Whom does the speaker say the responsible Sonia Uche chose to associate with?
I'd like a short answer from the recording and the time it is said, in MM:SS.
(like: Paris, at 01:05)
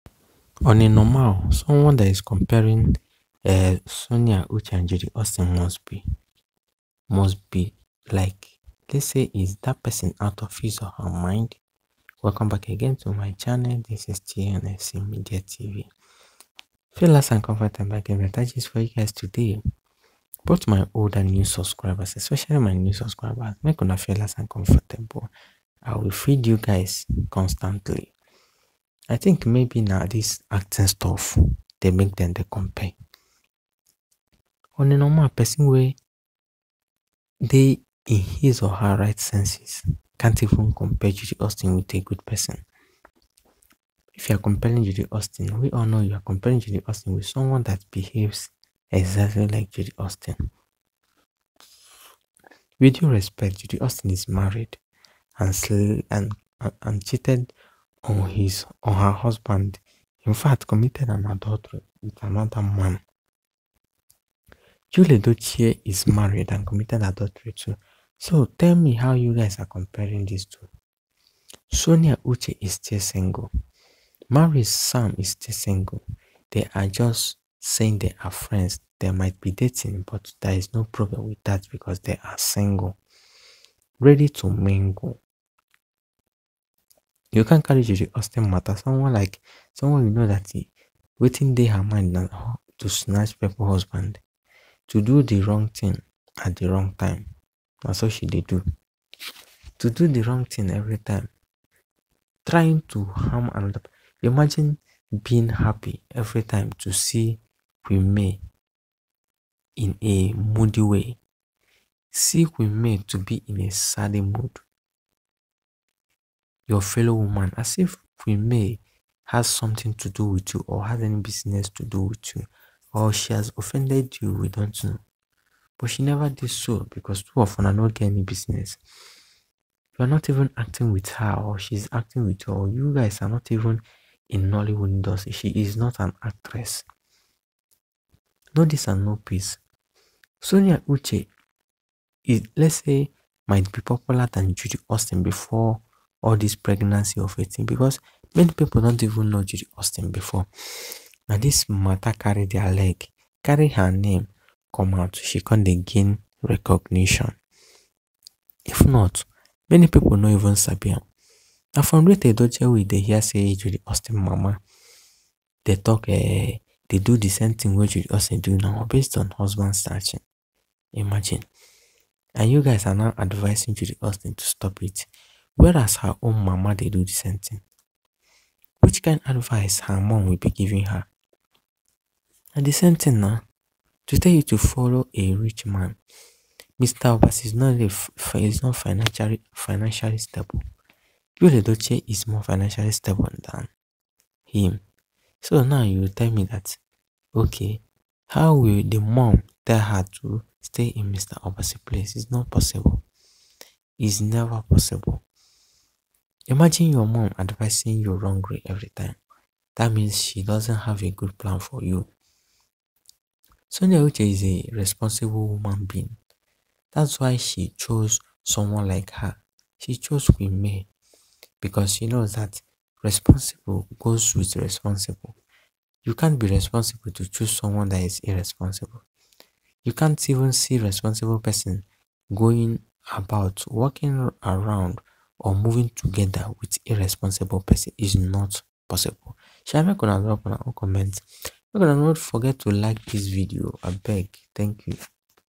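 Queen May, at 03:40.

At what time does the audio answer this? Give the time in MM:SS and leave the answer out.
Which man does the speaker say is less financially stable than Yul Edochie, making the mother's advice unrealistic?
03:06.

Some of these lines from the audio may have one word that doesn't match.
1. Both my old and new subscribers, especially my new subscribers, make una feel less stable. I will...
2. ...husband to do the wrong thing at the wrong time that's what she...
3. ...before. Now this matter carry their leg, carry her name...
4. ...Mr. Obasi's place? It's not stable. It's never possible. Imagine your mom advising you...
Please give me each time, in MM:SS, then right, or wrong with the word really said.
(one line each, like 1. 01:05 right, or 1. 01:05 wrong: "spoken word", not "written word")
1. 00:20 wrong: "uncomfortable", not "stable"
2. 01:33 right
3. 02:30 right
4. 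03:21 wrong: "possible", not "stable".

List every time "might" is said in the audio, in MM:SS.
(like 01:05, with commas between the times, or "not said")
01:19, 02:23.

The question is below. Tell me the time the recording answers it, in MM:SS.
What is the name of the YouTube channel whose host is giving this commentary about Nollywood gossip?
00:14.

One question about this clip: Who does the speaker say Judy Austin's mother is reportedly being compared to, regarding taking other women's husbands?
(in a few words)
Rita Edochie.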